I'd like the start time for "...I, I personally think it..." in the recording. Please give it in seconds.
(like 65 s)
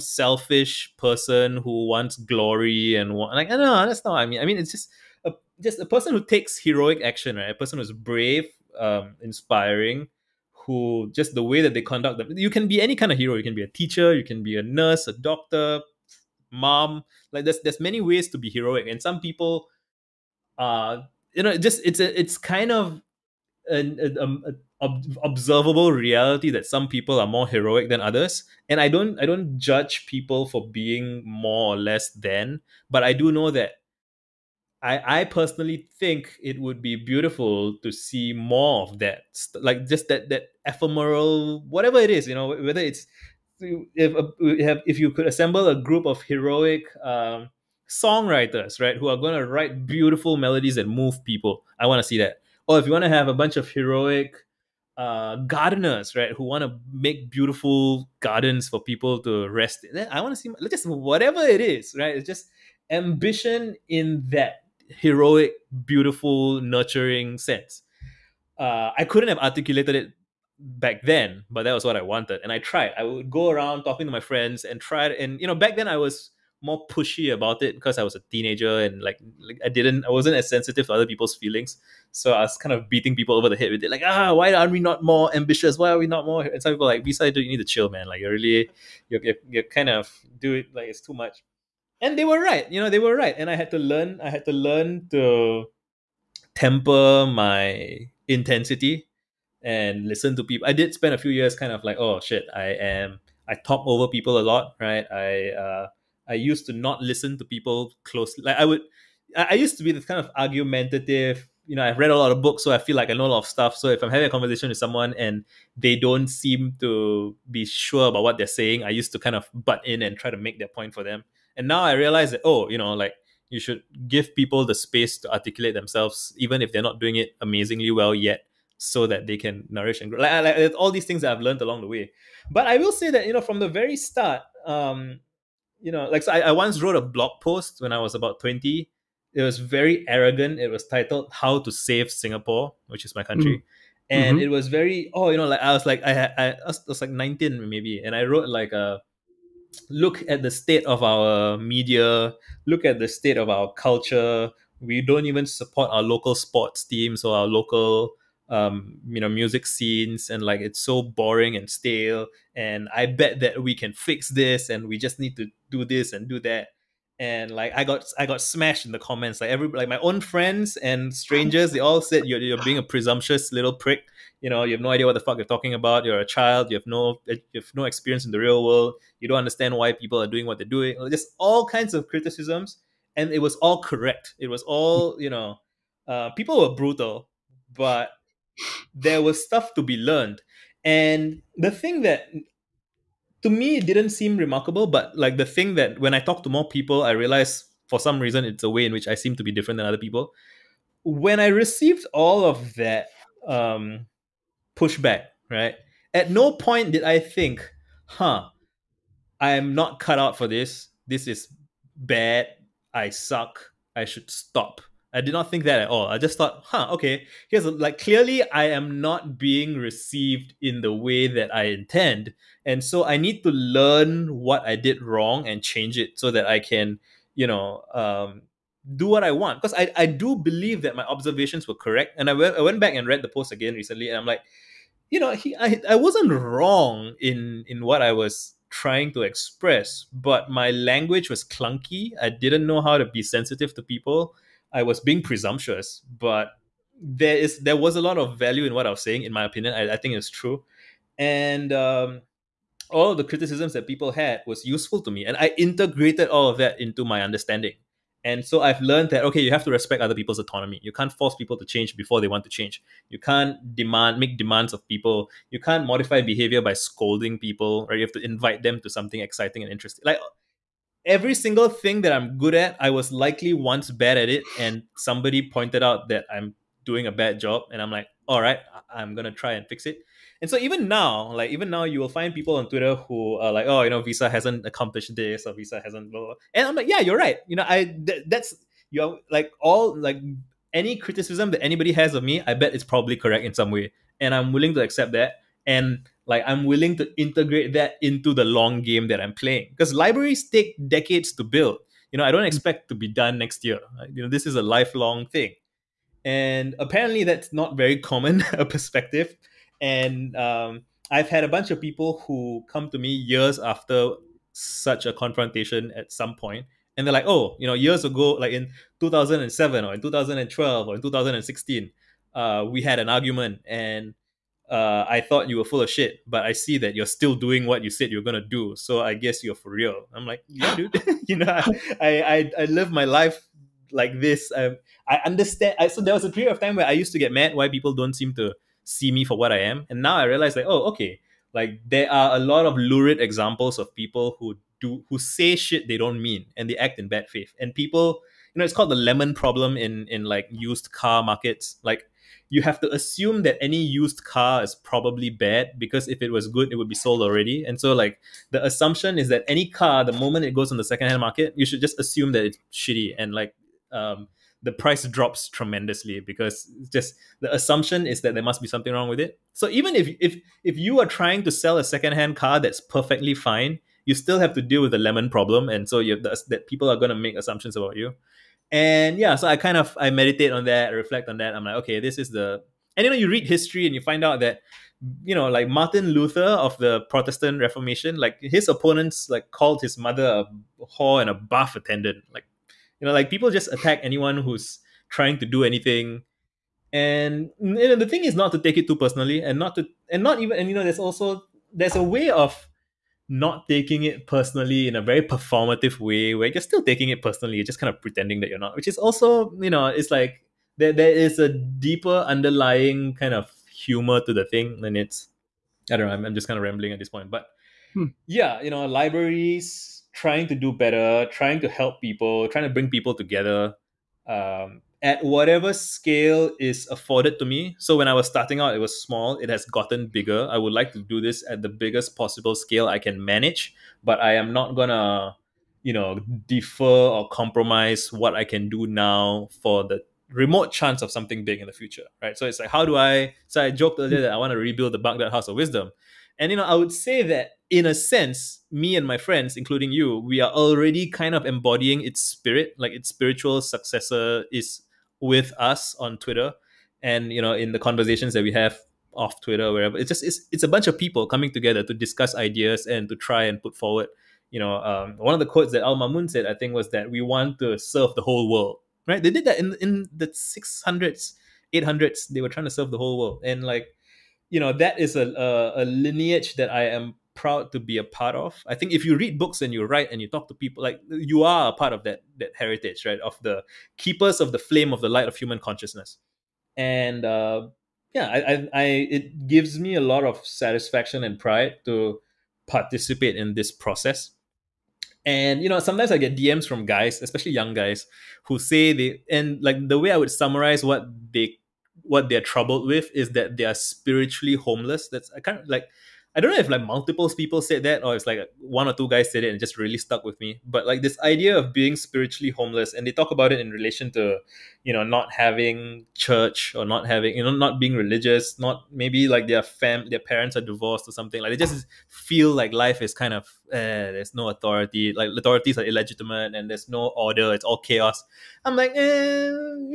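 34 s.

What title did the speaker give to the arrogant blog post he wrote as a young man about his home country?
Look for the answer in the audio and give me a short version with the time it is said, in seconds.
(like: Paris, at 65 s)
How to Save Singapore, at 141 s.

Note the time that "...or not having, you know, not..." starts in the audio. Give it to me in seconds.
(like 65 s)
516 s.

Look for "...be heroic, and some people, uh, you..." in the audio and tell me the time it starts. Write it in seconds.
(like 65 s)
18 s.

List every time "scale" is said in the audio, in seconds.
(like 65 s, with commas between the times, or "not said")
425 s, 432 s.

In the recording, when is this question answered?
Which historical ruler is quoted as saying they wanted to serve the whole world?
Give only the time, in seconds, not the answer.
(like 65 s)
465 s.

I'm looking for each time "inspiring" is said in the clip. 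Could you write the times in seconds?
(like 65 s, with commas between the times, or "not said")
9 s.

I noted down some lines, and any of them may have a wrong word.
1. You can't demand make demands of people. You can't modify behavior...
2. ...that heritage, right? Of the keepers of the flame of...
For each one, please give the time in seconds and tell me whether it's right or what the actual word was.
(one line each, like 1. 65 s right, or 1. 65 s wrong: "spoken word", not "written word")
1. 263 s right
2. 482 s right.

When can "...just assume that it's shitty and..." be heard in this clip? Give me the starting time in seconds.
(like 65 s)
361 s.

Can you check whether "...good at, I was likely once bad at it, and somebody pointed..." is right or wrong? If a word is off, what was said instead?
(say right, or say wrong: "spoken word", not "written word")
right.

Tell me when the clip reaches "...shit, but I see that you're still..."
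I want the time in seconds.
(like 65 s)
325 s.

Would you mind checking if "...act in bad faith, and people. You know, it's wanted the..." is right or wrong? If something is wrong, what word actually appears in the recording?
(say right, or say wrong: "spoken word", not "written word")
wrong: "called", not "wanted".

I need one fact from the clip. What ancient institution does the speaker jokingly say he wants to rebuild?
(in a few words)
Baghdad House of Wisdom.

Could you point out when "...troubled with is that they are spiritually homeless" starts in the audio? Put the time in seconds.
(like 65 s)
502 s.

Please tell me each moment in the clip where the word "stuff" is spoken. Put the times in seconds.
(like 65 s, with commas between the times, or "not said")
113 s, 189 s.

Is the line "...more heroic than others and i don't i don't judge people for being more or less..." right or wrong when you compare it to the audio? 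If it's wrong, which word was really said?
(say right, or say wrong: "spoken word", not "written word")
right.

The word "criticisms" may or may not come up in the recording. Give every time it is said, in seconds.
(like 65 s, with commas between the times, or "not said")
182 s, 253 s, 290 s.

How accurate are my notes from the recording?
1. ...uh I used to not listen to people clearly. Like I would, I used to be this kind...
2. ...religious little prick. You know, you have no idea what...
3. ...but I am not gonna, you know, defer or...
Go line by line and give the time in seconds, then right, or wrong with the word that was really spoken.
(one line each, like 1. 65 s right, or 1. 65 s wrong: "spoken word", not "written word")
1. 105 s wrong: "closely", not "clearly"
2. 172 s wrong: "presumptuous", not "religious"
3. 434 s right.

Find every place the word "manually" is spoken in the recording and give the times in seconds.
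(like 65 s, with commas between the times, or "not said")
not said.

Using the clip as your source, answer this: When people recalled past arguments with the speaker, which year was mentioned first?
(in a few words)
2007.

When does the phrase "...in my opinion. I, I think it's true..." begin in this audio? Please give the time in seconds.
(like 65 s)
249 s.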